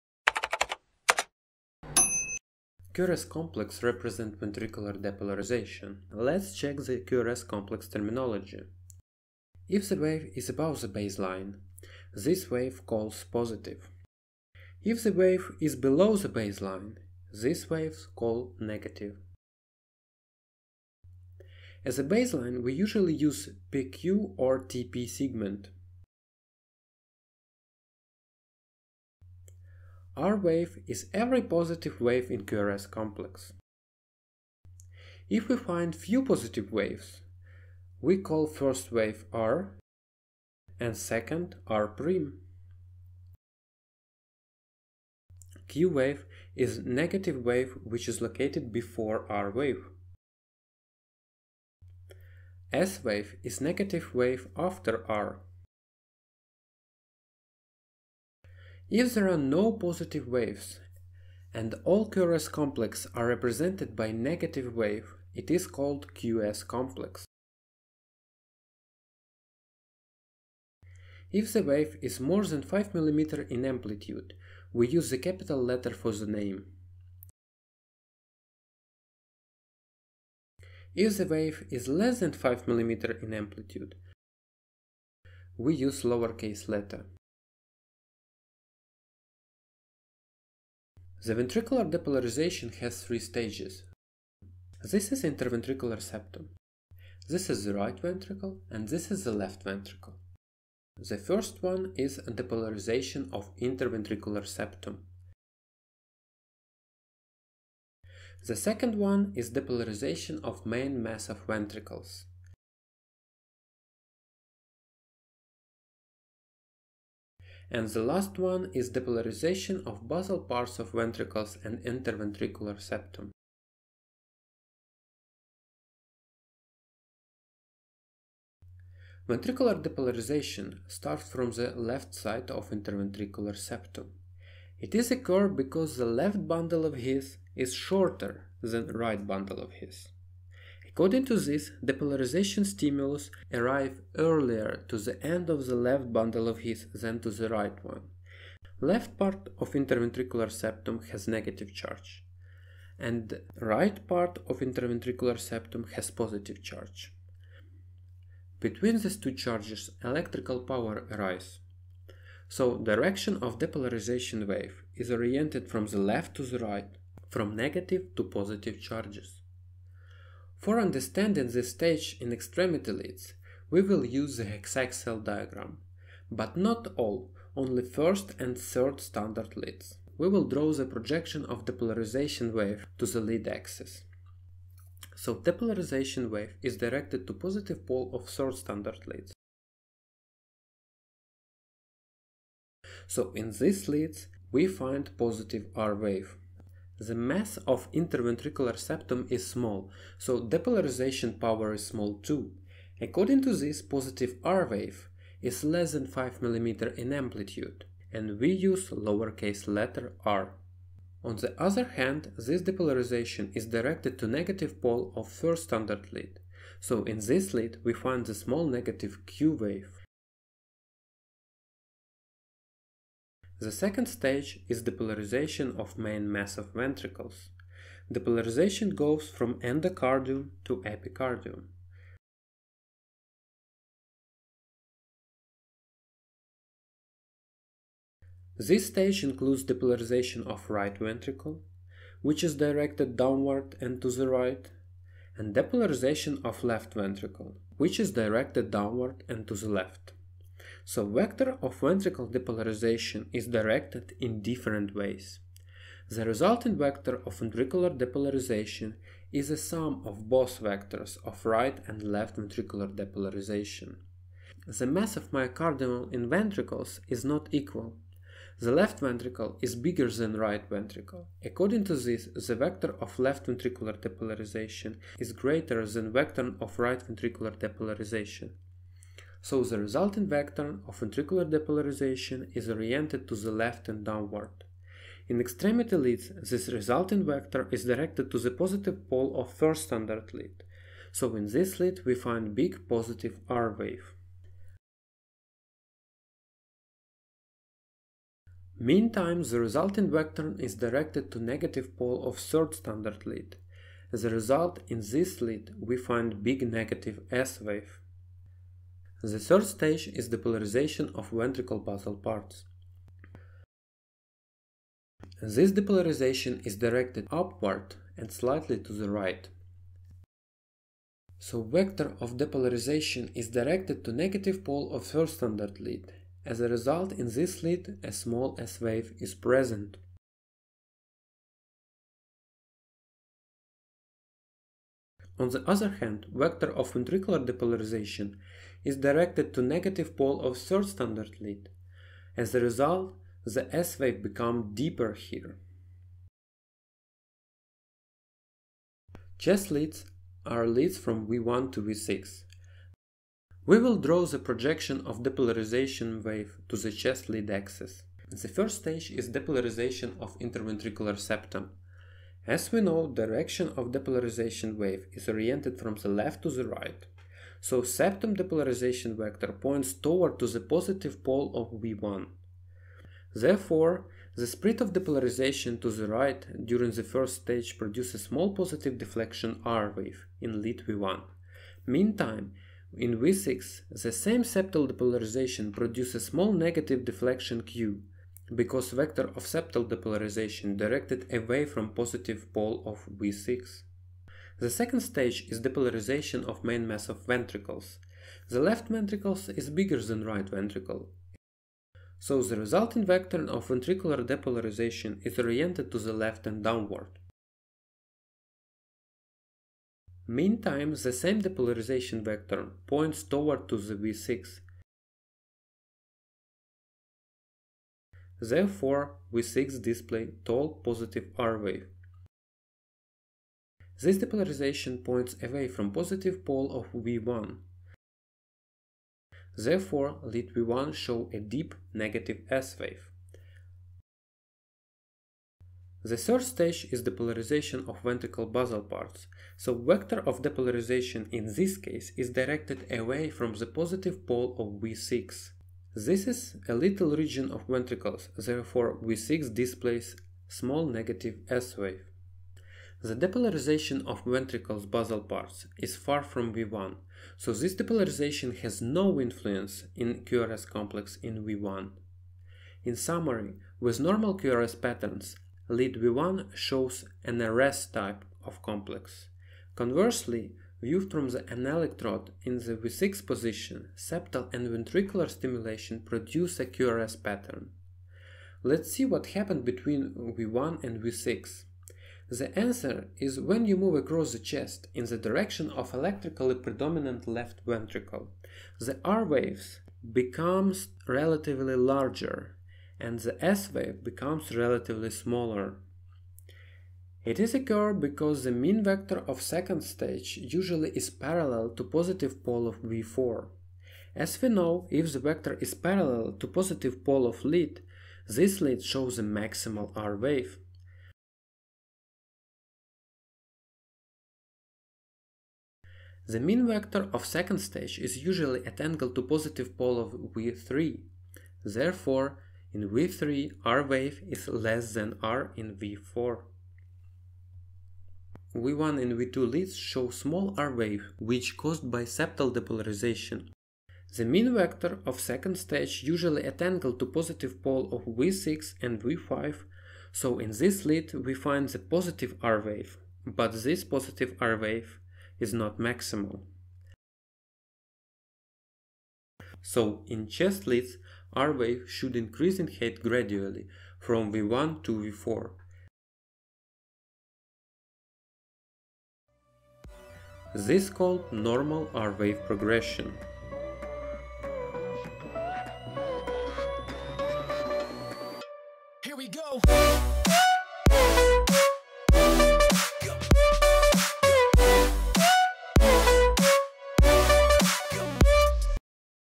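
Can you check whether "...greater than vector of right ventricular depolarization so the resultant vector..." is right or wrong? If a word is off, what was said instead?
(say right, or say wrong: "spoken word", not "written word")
right.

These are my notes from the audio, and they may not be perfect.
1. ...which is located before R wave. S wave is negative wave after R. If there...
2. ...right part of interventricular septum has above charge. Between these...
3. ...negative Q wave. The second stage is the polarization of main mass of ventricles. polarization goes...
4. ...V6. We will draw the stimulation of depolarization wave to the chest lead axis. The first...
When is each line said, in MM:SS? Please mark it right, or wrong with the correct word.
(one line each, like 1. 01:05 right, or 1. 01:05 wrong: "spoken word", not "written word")
1. 00:47 right
2. 02:33 wrong: "positive", not "above"
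3. 03:38 right
4. 05:51 wrong: "projection", not "stimulation".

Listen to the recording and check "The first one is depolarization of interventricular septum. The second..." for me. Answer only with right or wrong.
right.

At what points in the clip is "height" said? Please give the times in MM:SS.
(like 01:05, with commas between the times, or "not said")
09:12.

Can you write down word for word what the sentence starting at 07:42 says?
In summary, with normal QRS patterns, lead V1 shows an rS type of complex.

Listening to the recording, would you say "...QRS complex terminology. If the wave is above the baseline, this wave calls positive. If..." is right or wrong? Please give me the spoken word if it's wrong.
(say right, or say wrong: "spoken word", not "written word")
right.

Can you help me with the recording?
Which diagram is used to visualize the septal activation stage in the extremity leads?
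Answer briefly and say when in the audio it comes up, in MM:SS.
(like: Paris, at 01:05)
hexaxial diagram, at 02:54.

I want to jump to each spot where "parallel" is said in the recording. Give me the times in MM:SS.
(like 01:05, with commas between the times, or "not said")
08:21, 08:25.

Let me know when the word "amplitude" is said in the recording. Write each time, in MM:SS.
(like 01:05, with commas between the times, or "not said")
01:13, 01:23, 03:27.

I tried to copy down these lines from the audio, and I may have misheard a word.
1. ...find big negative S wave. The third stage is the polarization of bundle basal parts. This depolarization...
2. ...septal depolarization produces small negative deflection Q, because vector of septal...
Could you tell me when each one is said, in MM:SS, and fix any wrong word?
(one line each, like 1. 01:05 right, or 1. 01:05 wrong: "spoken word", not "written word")
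1. 05:05 wrong: "ventricle", not "bundle"
2. 06:24 right.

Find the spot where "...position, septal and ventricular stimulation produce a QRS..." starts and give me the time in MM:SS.
07:53.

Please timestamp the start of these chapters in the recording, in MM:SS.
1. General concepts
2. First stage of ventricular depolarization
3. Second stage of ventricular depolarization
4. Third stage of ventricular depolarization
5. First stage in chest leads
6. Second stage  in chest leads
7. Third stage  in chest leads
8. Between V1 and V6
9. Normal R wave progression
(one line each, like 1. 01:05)
1. 01:30
2. 02:10
3. 03:42
4. 05:10
5. 05:50
6. 06:35
7. 07:15
8. 08:01
9. 09:07.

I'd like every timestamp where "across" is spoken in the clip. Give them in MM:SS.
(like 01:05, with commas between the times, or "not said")
08:03.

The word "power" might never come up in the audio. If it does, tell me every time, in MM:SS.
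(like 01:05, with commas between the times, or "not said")
02:40, 03:21.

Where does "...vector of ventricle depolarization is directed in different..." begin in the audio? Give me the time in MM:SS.
04:11.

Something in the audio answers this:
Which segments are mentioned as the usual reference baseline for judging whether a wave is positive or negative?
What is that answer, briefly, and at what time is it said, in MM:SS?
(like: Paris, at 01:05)
PQ or TP segment, at 00:23.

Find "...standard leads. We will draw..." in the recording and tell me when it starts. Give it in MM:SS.
02:59.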